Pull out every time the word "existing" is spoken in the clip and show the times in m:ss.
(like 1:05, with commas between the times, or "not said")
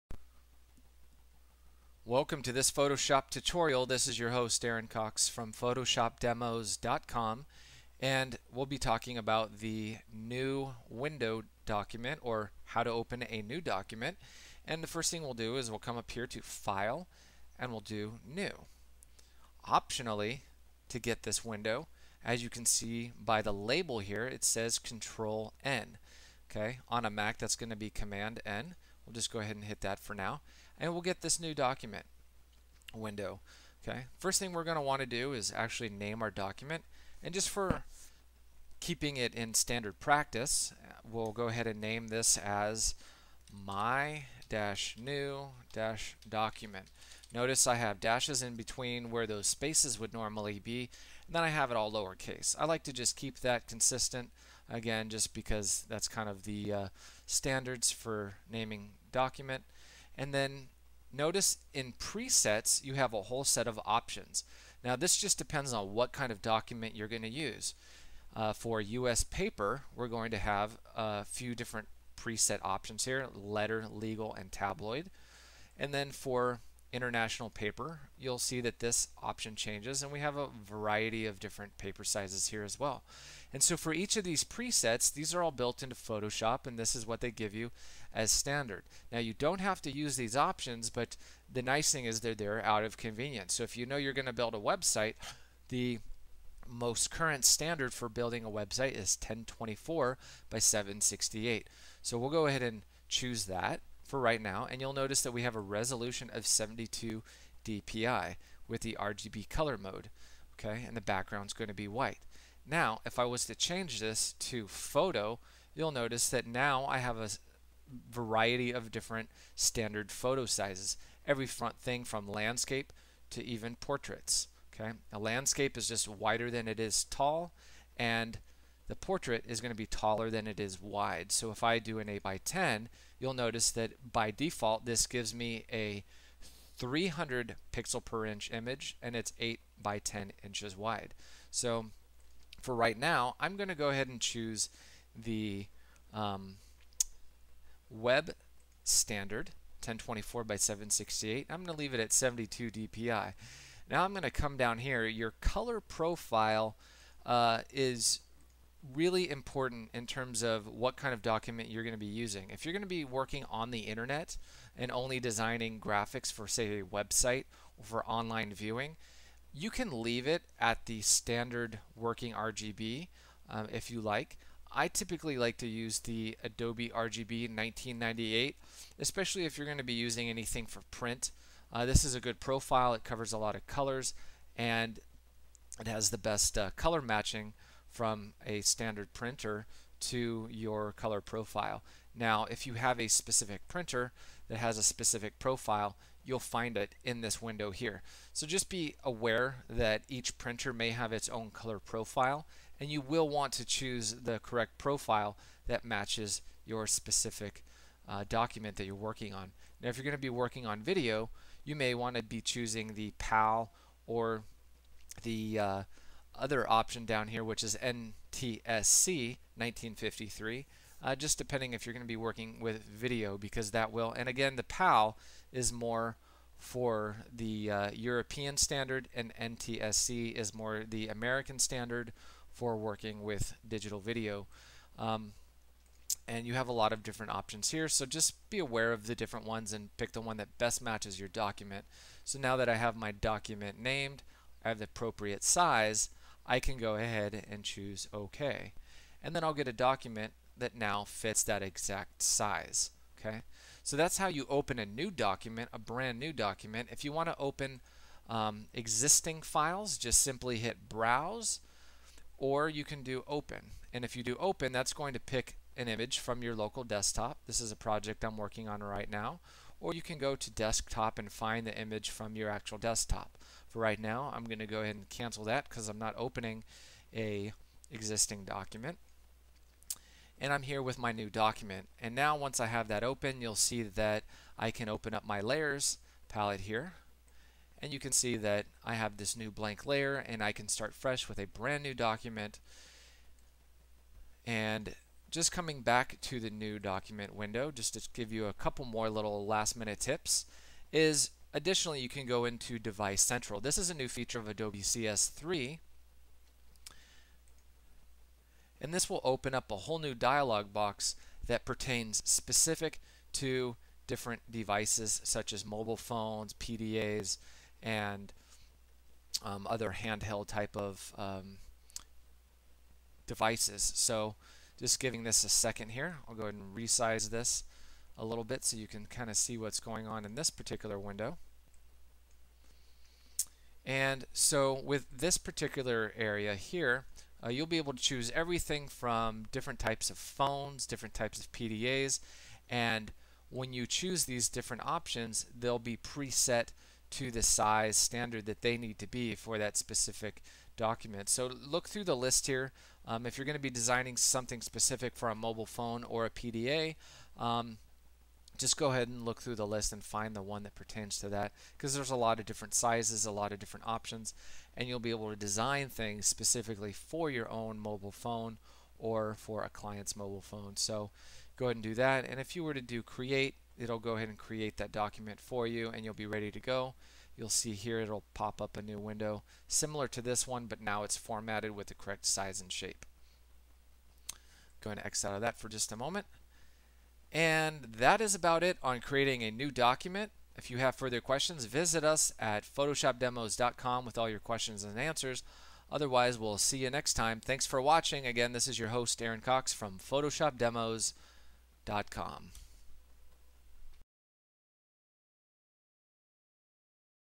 4:18, 4:37.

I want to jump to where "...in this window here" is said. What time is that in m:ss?
3:17.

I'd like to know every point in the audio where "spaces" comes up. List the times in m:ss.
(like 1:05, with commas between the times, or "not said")
0:49.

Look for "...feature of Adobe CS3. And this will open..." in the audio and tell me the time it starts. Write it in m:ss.
5:04.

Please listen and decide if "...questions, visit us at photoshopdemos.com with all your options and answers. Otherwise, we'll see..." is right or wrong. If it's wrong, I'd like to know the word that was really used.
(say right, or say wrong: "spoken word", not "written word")
wrong: "questions", not "options".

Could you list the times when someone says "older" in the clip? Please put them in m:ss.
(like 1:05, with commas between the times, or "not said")
not said.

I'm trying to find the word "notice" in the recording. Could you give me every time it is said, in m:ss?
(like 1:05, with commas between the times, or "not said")
0:47, 1:01, 1:44, 1:55, 2:13.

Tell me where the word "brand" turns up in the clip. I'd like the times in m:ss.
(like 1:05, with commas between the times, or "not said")
4:15, 4:51.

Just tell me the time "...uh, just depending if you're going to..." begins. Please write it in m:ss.
3:41.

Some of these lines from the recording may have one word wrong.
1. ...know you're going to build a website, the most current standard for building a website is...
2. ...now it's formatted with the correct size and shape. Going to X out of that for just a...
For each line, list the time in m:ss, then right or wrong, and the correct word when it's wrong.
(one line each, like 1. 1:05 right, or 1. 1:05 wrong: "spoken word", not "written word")
1. 1:33 right
2. 6:20 right.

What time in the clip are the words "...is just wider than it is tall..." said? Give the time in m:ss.
2:05.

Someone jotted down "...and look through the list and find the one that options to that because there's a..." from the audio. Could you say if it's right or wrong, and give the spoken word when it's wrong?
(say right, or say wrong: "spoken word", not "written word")
wrong: "pertains", not "options".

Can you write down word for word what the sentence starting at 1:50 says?
And the background's going to be white.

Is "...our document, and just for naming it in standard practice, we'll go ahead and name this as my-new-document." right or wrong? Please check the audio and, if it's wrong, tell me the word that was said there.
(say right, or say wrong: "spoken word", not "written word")
wrong: "keeping", not "naming".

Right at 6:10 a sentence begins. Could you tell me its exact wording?
So go ahead and do that.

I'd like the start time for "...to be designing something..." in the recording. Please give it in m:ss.
5:53.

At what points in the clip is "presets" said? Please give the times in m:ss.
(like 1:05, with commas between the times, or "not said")
1:01, 1:12, 1:24, 5:45.